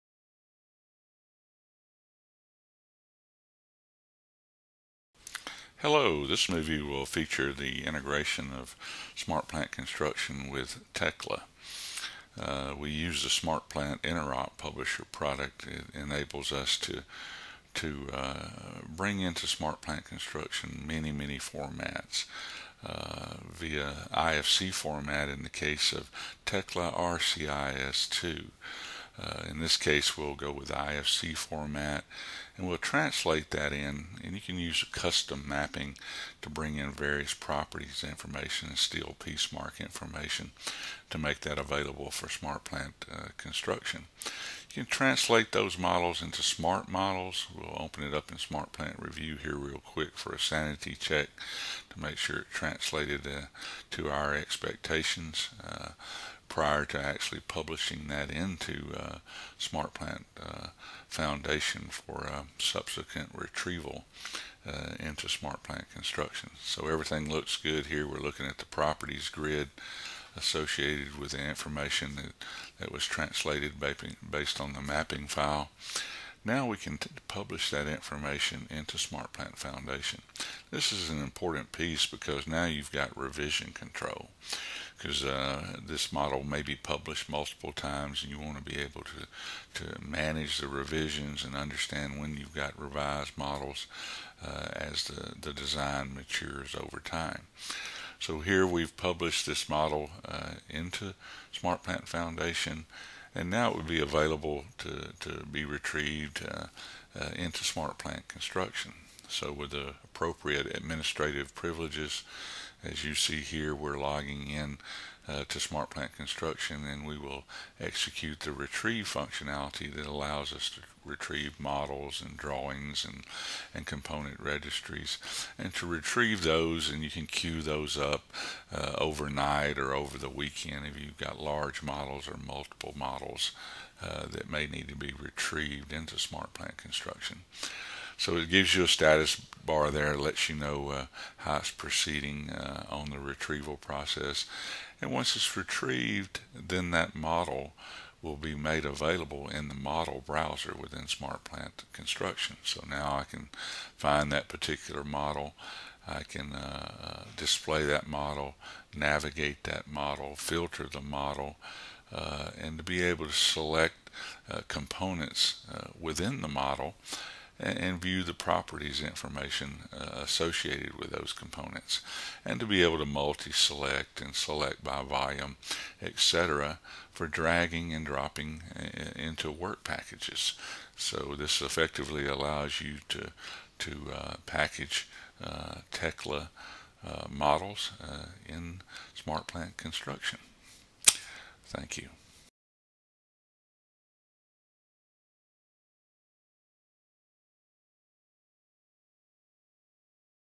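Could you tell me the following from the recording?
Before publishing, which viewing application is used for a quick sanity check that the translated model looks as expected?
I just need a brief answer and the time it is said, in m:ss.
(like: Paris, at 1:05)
Smart Plant Review, at 0:48.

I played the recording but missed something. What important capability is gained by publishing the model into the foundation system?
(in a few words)
Revision control.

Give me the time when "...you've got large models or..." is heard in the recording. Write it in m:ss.
2:10.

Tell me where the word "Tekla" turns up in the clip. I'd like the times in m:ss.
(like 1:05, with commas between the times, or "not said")
0:10, 0:26, 3:05.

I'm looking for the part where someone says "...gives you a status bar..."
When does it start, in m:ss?
2:18.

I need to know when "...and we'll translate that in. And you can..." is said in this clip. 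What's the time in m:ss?
0:32.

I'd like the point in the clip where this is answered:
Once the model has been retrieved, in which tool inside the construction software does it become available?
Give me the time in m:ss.
2:29.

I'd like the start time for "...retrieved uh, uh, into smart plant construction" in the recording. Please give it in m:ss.
1:45.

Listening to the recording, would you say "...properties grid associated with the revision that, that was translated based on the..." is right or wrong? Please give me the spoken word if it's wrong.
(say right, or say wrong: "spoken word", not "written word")
wrong: "information", not "revision".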